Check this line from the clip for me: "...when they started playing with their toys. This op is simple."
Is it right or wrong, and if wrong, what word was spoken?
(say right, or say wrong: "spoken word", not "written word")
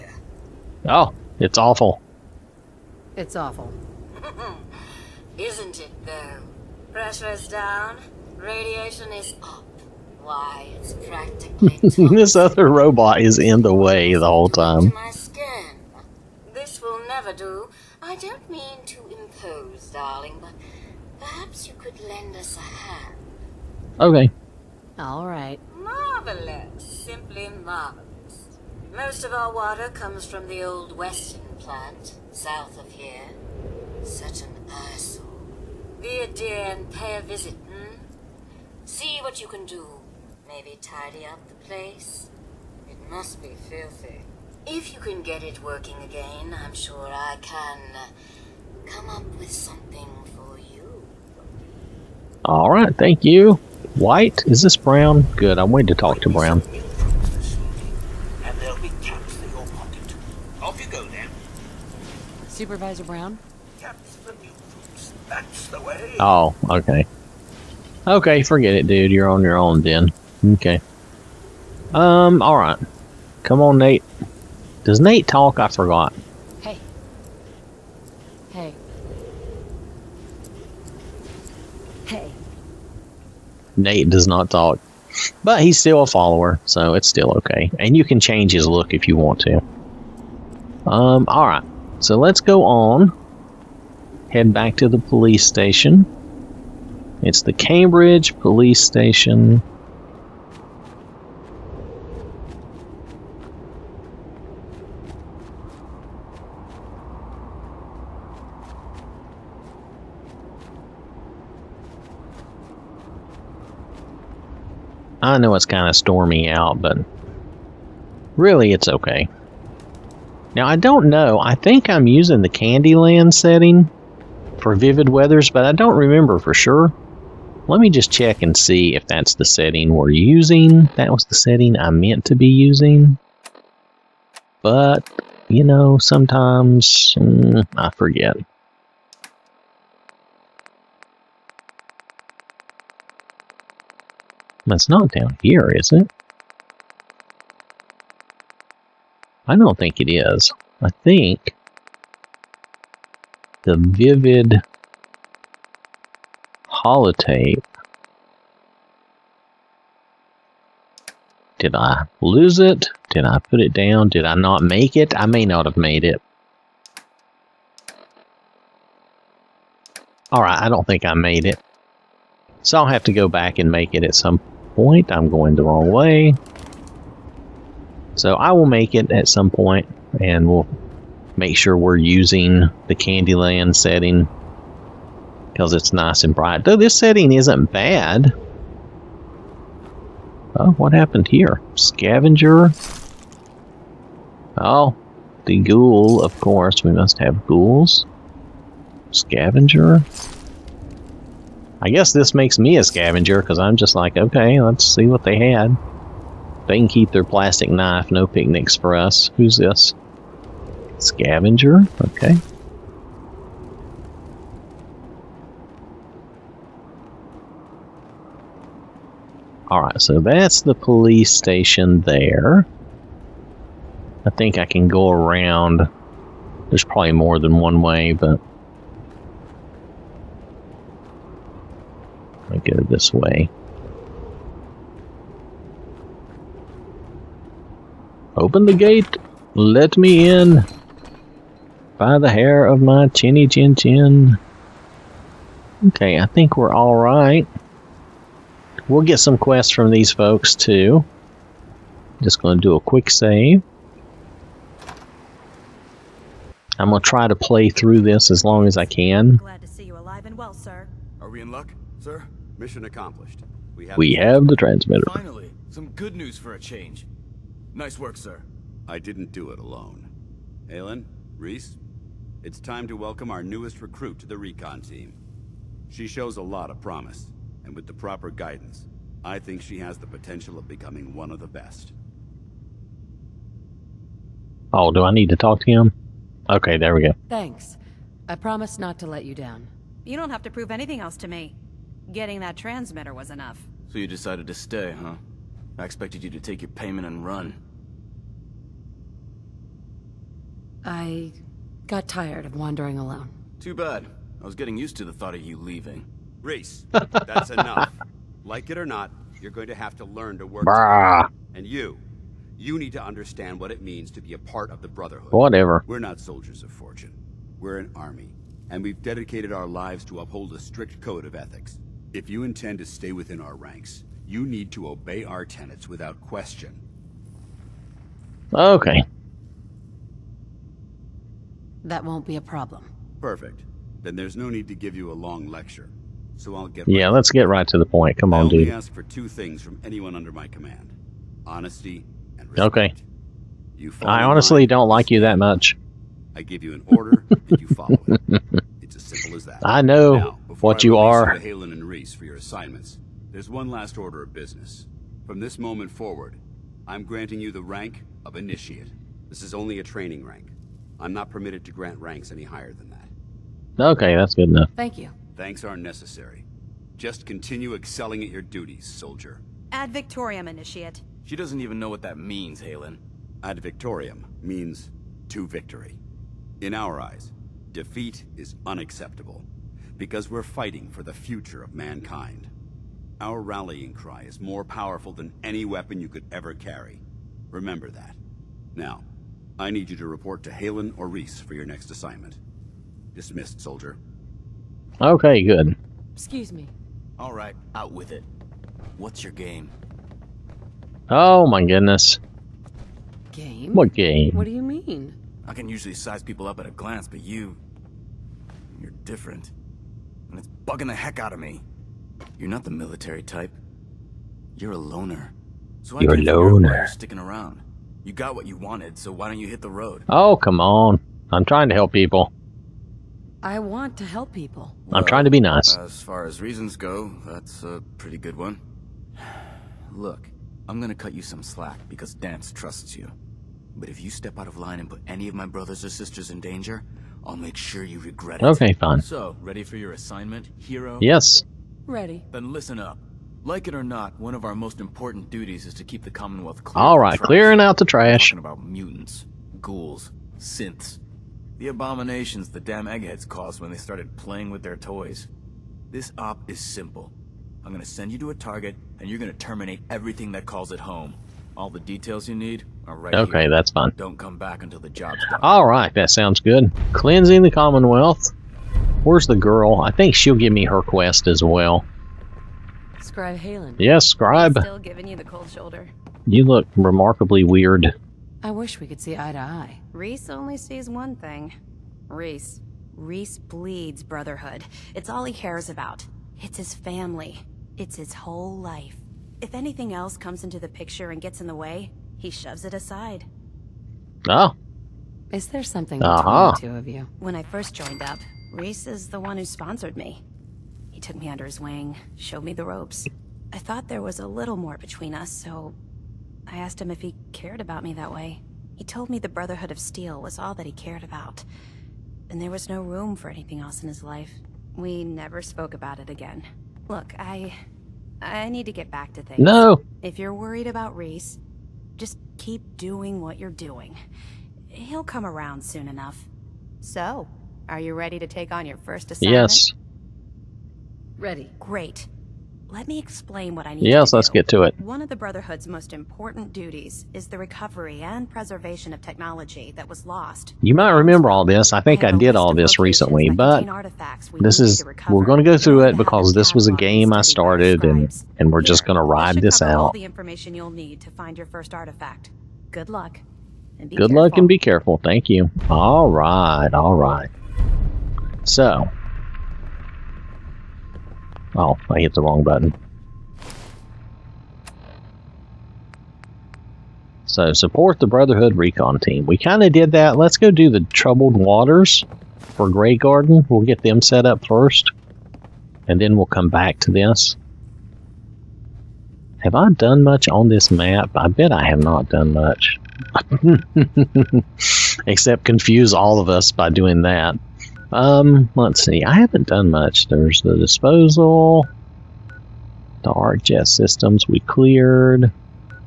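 right.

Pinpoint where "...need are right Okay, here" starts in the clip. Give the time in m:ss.
7:42.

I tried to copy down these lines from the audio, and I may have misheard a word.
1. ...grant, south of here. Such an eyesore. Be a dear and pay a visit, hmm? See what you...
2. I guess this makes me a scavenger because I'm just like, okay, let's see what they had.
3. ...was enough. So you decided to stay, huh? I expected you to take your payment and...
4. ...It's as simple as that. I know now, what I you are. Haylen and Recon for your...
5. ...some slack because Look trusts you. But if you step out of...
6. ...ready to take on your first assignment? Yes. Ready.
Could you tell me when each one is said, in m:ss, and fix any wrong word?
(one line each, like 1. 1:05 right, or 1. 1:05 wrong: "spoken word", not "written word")
1. 0:31 wrong: "plant", not "grant"
2. 3:21 right
3. 4:53 right
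4. 5:48 wrong: "Rhys", not "Recon"
5. 7:11 wrong: "Danse", not "Look"
6. 8:47 right.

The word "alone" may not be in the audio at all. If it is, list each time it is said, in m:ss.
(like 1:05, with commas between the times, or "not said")
4:29, 5:02.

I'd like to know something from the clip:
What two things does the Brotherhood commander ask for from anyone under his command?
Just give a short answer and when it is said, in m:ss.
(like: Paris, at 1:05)
Honesty and respect, at 5:41.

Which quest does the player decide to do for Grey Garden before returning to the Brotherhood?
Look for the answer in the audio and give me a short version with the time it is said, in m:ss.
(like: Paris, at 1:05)
Troubled Waters, at 9:30.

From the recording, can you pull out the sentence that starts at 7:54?
still giving you the cold shoulder.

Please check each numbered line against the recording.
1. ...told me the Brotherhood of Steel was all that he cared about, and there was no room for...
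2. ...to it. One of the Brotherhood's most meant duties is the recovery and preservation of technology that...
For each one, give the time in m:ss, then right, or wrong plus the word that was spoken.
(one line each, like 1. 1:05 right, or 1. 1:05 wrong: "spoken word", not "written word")
1. 8:28 right
2. 8:54 wrong: "important", not "meant".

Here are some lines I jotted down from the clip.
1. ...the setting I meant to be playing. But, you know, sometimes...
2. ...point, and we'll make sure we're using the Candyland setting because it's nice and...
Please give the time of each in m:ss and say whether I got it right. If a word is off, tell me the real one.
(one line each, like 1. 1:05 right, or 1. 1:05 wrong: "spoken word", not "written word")
1. 2:11 wrong: "using", not "playing"
2. 2:59 right.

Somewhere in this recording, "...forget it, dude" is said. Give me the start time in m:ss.
1:08.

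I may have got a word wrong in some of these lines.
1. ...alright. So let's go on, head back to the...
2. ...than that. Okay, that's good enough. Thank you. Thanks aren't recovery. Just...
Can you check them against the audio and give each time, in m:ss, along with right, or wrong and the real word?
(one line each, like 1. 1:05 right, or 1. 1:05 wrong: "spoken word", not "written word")
1. 1:31 right
2. 6:02 wrong: "necessary", not "recovery".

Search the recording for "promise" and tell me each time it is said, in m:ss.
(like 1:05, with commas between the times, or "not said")
4:36, 4:48.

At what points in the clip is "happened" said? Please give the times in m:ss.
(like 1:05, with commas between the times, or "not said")
3:10.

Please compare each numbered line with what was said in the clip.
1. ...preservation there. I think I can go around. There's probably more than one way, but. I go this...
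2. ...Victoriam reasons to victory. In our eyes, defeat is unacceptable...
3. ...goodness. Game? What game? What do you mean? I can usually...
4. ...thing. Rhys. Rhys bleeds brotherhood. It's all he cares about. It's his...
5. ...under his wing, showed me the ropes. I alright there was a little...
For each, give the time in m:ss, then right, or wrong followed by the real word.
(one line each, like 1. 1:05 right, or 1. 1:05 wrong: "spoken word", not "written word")
1. 3:41 wrong: "station", not "preservation"
2. 6:13 wrong: "means", not "reasons"
3. 6:41 right
4. 8:01 right
5. 8:21 wrong: "thought", not "alright".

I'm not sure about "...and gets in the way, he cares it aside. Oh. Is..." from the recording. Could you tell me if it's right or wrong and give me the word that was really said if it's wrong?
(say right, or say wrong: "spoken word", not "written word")
wrong: "shoves", not "cares".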